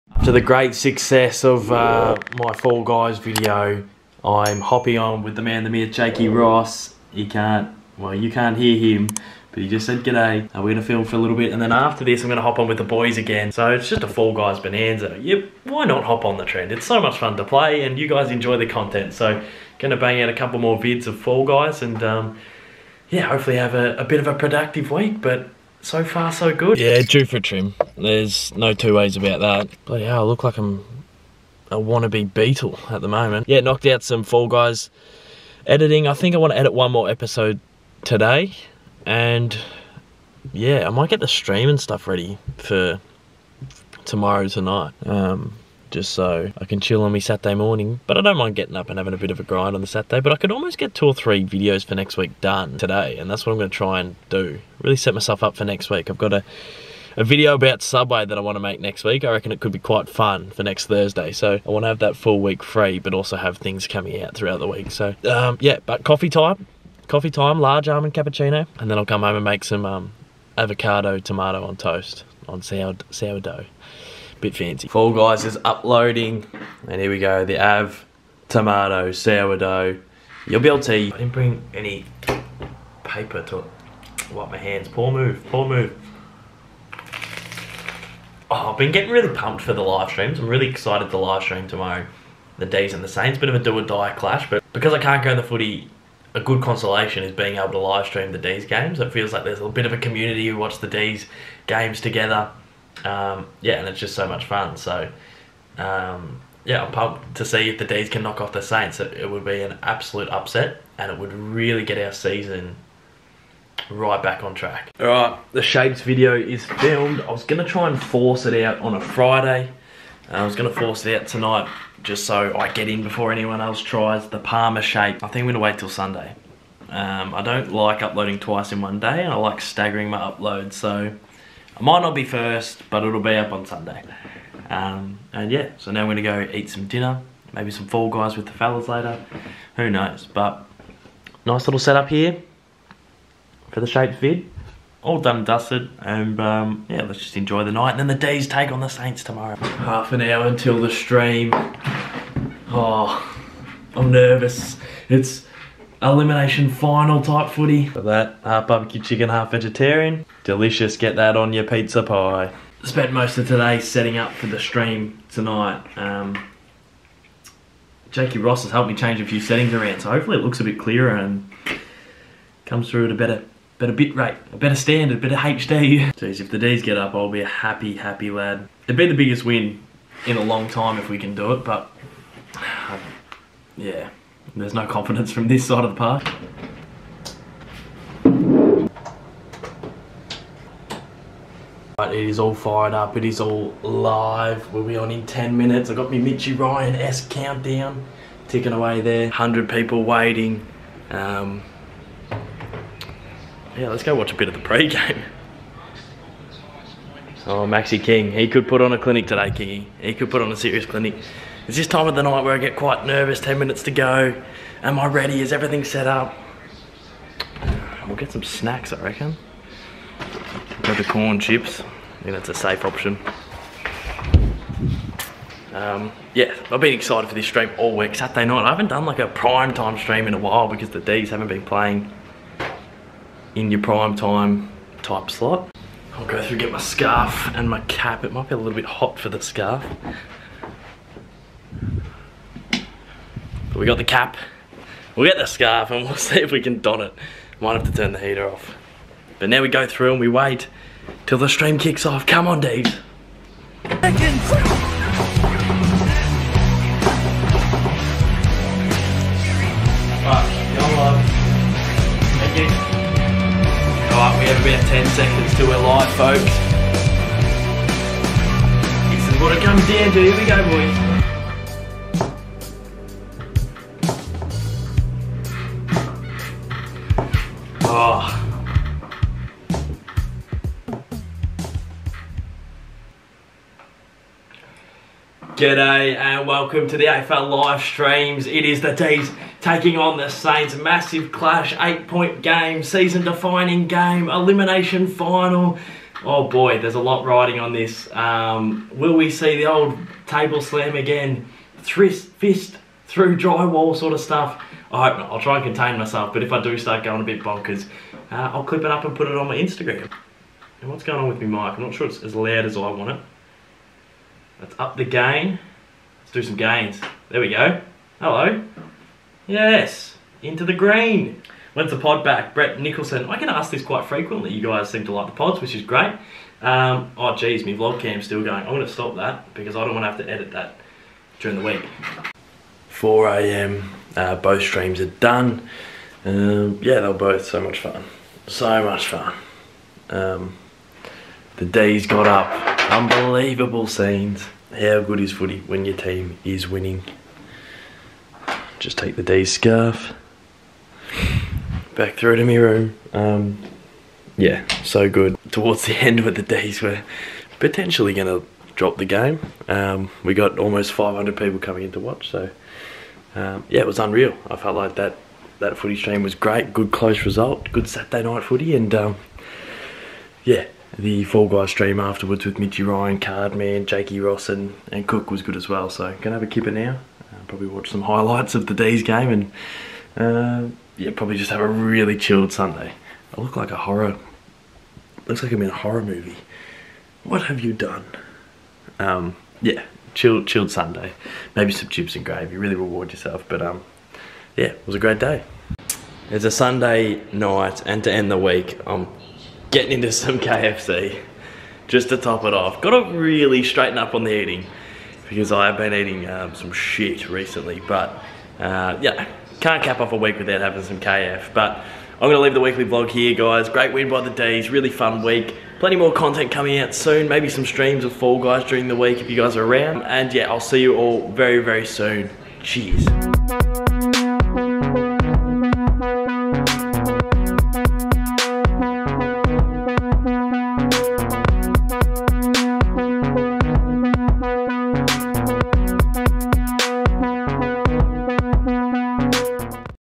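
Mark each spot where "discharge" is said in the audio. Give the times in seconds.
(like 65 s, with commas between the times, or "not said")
not said.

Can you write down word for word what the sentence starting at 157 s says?
For that, half barbecue chicken, half vegetarian.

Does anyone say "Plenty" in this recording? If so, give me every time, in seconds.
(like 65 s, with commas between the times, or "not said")
415 s.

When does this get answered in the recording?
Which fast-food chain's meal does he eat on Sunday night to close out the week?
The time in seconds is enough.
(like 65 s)
400 s.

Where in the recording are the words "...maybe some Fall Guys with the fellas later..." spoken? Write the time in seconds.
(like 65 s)
137 s.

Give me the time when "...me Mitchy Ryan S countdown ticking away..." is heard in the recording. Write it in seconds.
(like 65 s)
196 s.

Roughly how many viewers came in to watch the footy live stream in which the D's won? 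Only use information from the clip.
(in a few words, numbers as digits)
almost 500.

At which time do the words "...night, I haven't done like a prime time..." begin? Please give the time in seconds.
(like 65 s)
228 s.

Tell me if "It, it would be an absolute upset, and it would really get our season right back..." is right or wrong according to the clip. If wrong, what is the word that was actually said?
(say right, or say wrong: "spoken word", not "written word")
right.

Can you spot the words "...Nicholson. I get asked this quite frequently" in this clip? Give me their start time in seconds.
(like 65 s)
322 s.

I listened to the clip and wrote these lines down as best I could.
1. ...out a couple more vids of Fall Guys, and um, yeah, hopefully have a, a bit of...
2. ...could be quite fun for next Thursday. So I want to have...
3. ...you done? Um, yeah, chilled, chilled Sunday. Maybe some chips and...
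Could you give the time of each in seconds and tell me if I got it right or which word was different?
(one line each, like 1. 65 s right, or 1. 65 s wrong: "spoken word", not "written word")
1. 20 s right
2. 59 s right
3. 387 s right.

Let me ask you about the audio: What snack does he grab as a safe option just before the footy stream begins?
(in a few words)
corn chips.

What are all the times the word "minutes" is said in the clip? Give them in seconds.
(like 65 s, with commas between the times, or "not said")
195 s, 213 s.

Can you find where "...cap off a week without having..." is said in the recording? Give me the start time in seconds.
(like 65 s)
409 s.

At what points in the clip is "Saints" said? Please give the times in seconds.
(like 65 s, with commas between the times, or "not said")
93 s, 108 s, 148 s, 290 s.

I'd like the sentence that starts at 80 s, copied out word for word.
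I didn't bring any paper to wipe my hands.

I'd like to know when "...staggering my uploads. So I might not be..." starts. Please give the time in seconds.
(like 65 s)
129 s.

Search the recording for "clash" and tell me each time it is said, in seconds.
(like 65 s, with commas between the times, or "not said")
94 s, 291 s.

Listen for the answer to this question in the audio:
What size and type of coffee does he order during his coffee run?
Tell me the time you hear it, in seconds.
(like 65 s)
67 s.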